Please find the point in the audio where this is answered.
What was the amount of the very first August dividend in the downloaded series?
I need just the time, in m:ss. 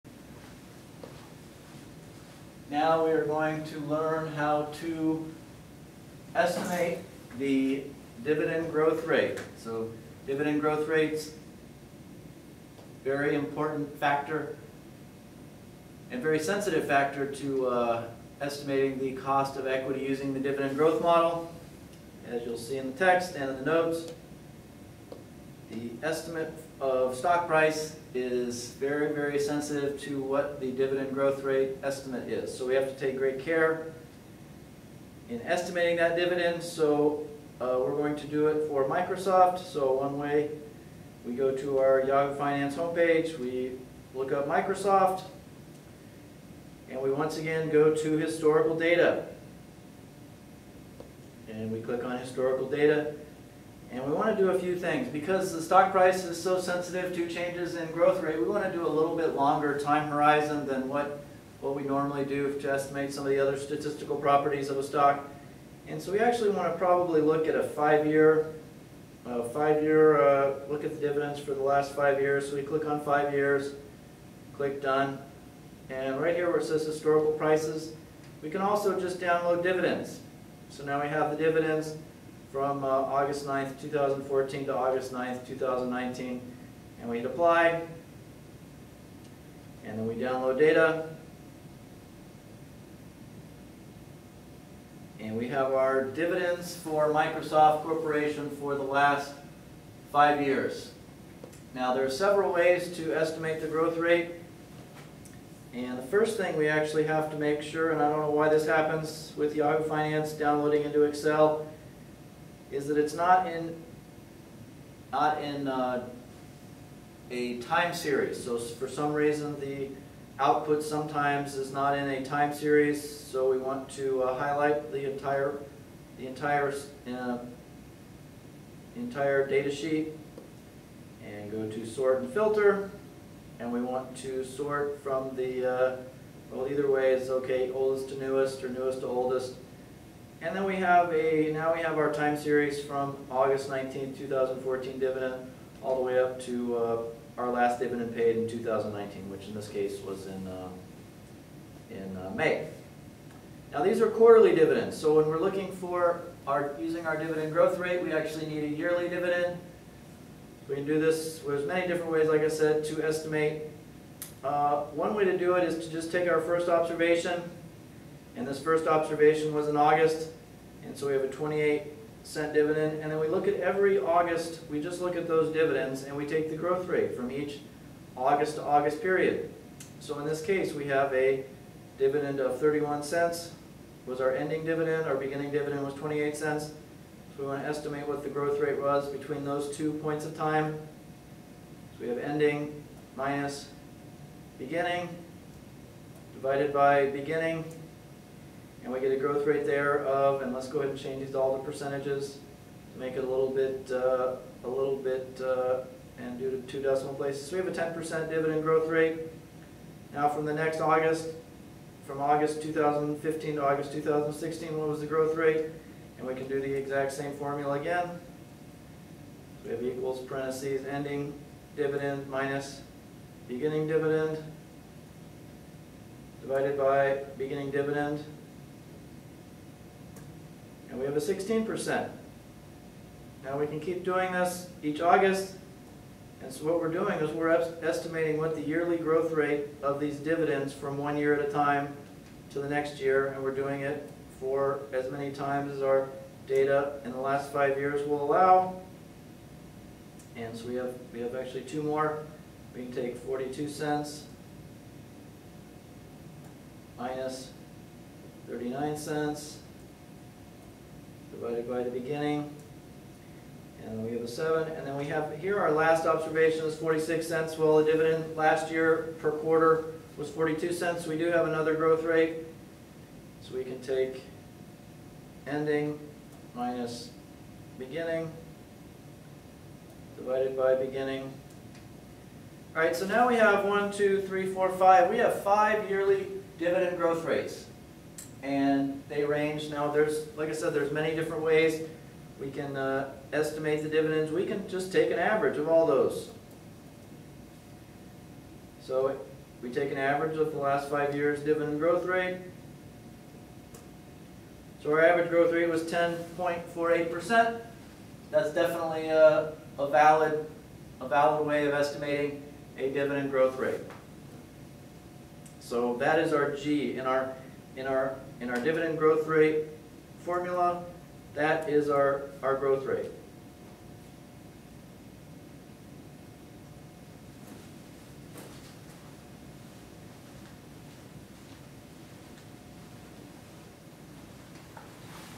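3:05.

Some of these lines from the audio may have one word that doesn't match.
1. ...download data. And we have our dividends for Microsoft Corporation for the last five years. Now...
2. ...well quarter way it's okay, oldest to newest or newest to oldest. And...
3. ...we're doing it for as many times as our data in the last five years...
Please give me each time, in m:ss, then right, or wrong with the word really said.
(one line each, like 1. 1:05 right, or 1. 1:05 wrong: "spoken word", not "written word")
1. 1:30 right
2. 2:16 wrong: "either", not "quarter"
3. 4:03 right.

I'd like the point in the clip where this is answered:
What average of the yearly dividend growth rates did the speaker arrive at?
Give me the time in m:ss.
5:05.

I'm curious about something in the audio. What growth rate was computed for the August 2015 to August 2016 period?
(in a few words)
16%.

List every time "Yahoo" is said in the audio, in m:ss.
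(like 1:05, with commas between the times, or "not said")
0:42, 1:49.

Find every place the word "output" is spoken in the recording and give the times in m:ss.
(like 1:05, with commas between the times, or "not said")
2:00.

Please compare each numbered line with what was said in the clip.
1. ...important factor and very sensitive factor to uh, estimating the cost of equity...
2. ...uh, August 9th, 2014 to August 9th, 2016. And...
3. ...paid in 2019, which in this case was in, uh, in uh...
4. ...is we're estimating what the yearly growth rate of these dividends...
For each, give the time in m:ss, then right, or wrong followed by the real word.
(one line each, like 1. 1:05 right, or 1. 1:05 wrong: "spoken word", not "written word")
1. 0:13 right
2. 1:22 wrong: "2019", not "2016"
3. 2:28 right
4. 3:57 right.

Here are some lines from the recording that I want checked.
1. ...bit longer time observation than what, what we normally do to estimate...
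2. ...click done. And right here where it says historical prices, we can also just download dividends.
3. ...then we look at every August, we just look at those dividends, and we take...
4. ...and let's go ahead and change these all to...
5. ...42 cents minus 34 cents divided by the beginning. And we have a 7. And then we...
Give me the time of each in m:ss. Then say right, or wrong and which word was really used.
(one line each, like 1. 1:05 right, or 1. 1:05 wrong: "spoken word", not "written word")
1. 0:59 wrong: "horizon", not "observation"
2. 1:14 right
3. 2:53 right
4. 3:20 right
5. 4:13 wrong: "39", not "34".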